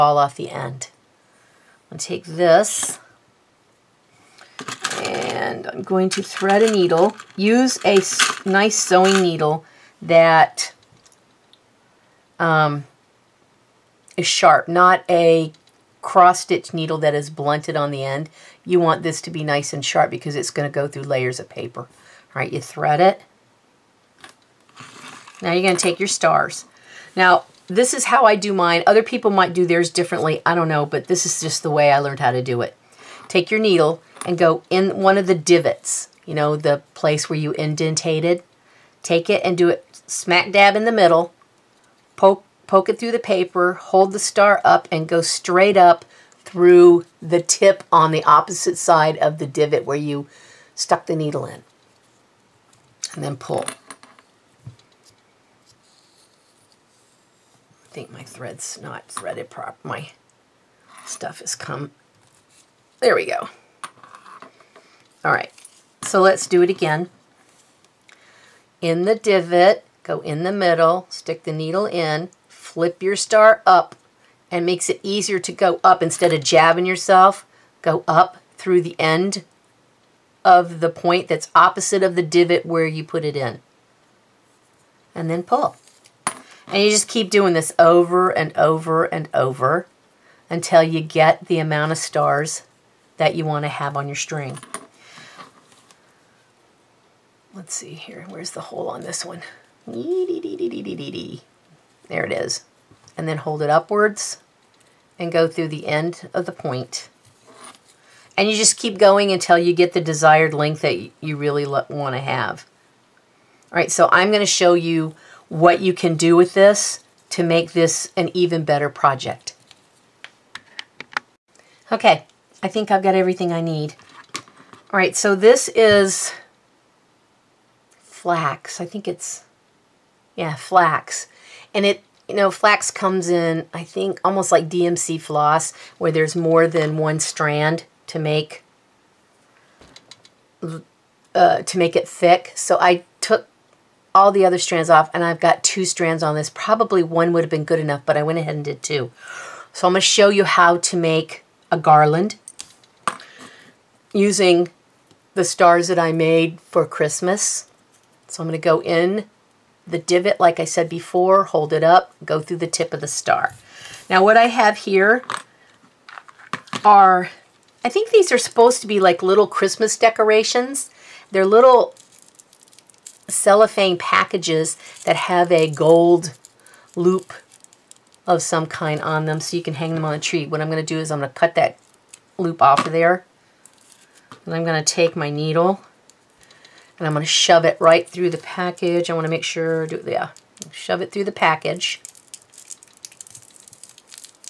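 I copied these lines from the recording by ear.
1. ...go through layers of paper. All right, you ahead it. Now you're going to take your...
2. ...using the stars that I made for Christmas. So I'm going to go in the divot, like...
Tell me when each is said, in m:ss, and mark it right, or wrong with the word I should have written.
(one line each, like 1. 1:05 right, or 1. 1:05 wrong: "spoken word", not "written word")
1. 0:20 wrong: "thread", not "ahead"
2. 2:34 right.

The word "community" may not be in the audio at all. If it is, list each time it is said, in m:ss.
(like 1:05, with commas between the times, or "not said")
not said.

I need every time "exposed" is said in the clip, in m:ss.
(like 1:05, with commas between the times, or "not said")
not said.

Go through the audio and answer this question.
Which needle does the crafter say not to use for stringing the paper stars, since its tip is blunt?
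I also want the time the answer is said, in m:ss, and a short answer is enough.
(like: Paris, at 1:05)
cross-stitch needle, at 0:15.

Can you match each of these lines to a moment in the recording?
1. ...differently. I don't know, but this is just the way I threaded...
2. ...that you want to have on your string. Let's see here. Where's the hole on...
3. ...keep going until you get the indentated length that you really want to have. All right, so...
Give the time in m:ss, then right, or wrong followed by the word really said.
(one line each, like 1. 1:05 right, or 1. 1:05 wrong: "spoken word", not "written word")
1. 0:29 wrong: "learned", not "threaded"
2. 1:33 right
3. 1:48 wrong: "desired", not "indentated".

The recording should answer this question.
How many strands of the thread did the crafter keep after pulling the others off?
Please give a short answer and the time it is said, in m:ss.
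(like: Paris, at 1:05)
2, at 2:25.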